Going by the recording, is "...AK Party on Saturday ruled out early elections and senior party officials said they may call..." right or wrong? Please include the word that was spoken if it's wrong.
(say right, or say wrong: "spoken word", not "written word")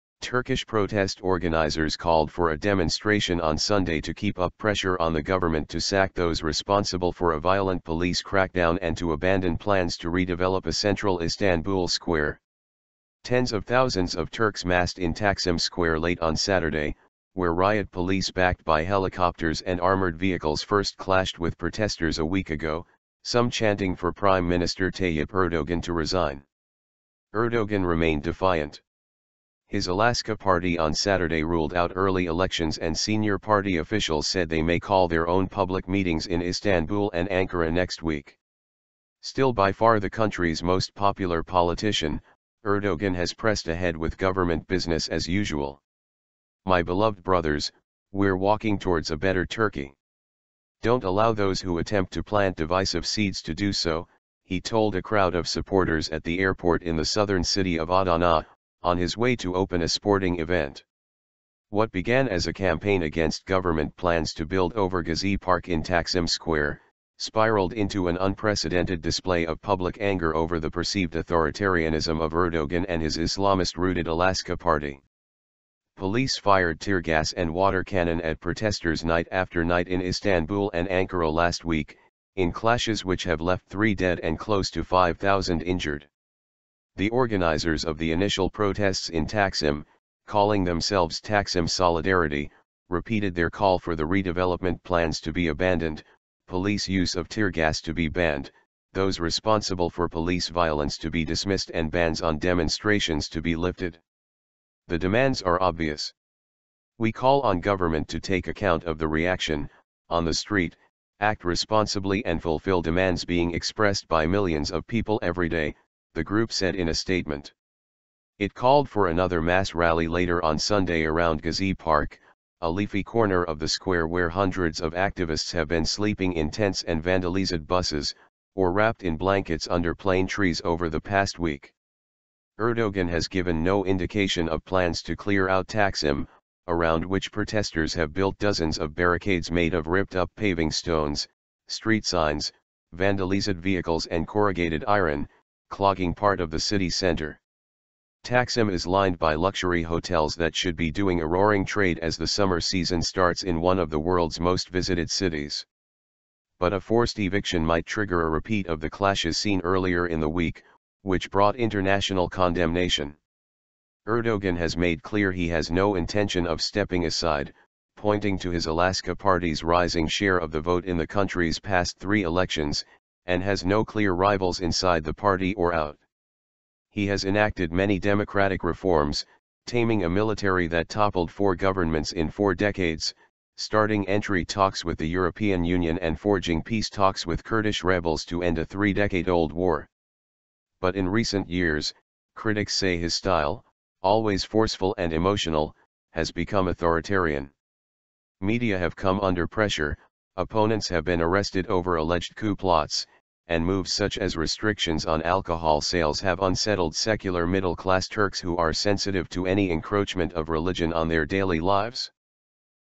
right.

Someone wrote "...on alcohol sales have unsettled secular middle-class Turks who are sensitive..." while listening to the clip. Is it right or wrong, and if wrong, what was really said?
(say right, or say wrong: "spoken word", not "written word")
right.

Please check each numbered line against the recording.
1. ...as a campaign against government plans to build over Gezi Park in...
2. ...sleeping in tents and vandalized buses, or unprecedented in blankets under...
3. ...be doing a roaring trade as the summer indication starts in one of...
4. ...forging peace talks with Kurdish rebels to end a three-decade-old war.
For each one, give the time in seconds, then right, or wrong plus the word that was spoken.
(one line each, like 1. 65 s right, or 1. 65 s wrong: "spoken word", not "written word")
1. 62 s right
2. 125 s wrong: "wrapped", not "unprecedented"
3. 150 s wrong: "season", not "indication"
4. 186 s right.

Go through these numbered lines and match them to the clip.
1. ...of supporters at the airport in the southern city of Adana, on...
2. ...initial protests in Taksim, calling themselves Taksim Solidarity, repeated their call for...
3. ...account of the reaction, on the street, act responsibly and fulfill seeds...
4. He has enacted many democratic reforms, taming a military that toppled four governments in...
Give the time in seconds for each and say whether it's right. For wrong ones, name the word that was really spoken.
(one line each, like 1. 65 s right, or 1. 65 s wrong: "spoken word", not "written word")
1. 55 s right
2. 88 s right
3. 108 s wrong: "demands", not "seeds"
4. 176 s right.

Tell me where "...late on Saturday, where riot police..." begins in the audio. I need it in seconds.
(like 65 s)
16 s.